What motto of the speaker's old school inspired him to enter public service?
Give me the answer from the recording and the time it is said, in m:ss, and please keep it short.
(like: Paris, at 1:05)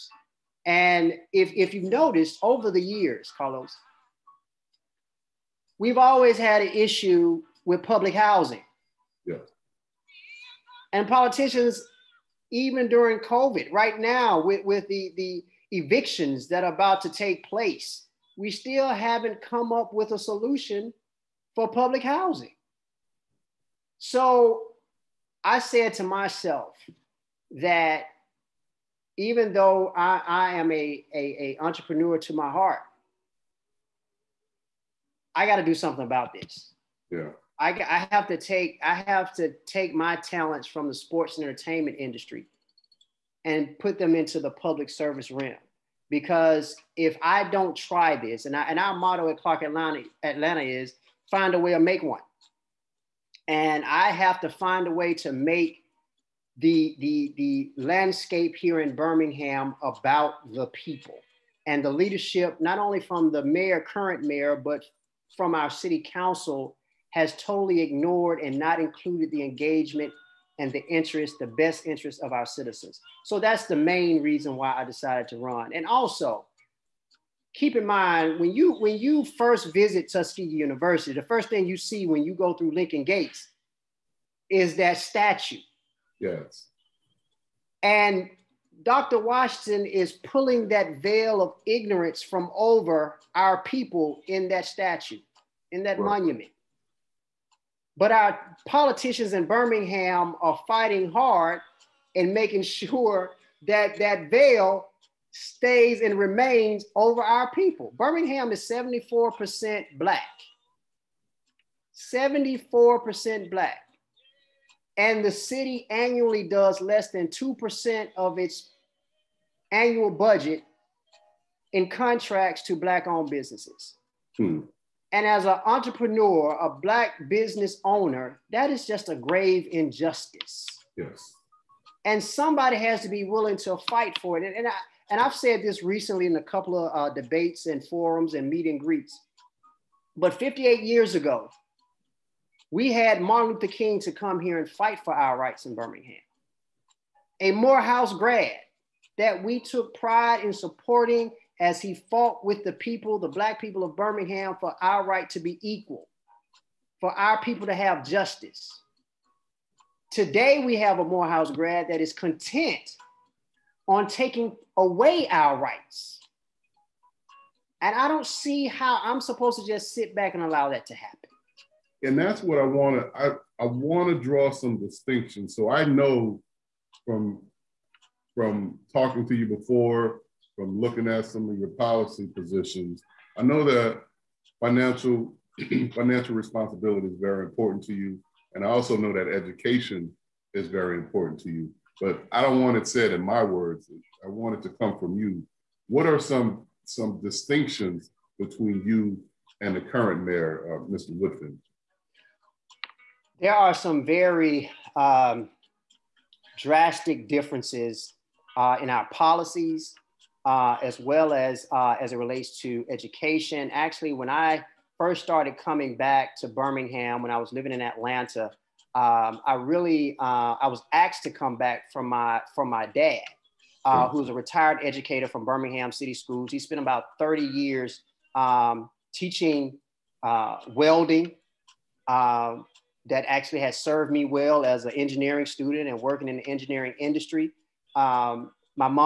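Find a way to make one, at 0:51.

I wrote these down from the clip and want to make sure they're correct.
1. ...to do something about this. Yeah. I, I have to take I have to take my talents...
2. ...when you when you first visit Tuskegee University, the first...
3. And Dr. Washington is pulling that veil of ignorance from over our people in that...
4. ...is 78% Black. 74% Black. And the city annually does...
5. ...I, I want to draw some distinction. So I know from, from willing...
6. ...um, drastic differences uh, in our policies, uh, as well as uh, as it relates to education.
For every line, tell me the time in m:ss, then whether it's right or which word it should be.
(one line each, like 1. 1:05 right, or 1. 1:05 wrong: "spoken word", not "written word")
1. 0:35 right
2. 1:18 right
3. 1:27 right
4. 1:48 wrong: "74", not "78"
5. 2:53 wrong: "talking", not "willing"
6. 3:24 right.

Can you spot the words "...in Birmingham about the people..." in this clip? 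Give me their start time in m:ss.
0:58.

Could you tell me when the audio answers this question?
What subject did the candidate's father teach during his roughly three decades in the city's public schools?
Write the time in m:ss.
3:50.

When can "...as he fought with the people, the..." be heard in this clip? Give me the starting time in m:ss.
2:31.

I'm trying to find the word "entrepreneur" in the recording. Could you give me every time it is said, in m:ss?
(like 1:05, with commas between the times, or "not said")
0:31, 2:05.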